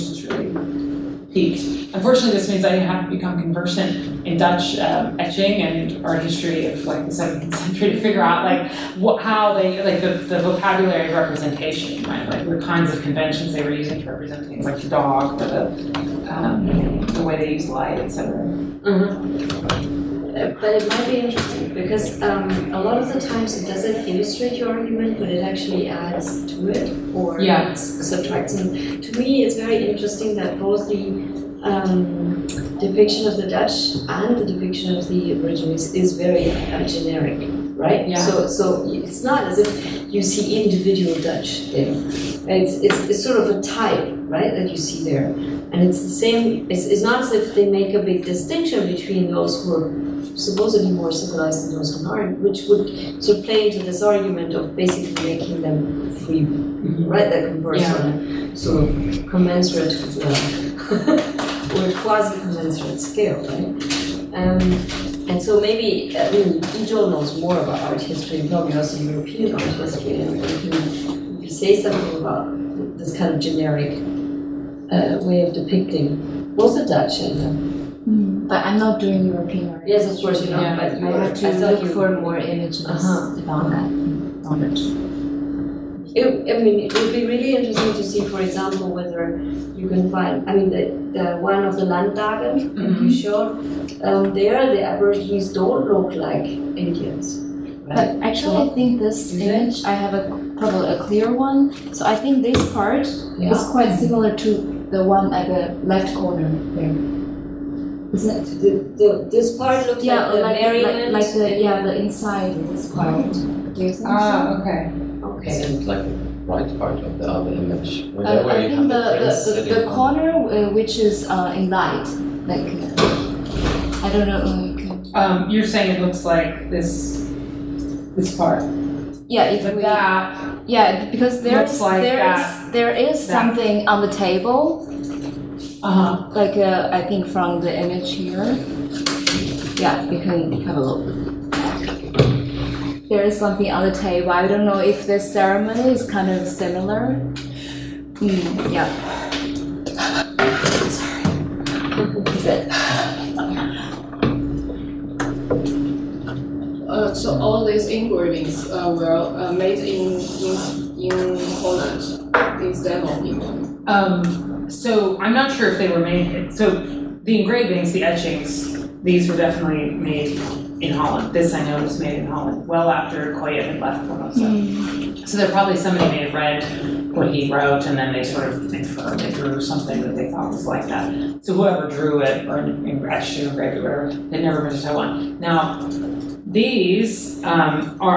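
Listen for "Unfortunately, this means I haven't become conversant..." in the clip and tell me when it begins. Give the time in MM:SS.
00:01.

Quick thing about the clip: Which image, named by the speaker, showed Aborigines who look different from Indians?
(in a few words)
Landdagen.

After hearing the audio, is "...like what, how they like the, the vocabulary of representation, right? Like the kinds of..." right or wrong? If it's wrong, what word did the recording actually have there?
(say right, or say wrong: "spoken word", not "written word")
right.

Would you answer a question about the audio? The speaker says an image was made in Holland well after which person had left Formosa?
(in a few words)
Coyett.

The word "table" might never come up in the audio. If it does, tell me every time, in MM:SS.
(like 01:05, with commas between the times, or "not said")
02:14, 02:23.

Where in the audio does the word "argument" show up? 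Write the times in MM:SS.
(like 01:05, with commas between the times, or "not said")
00:24, 00:54.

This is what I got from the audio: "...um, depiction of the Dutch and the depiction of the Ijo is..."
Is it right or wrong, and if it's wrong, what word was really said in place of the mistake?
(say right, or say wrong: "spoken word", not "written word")
wrong: "Aborigines", not "Ijo".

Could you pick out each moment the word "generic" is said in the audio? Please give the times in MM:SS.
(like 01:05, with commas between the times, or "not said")
00:36, 01:13.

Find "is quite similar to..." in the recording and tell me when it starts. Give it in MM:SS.
01:43.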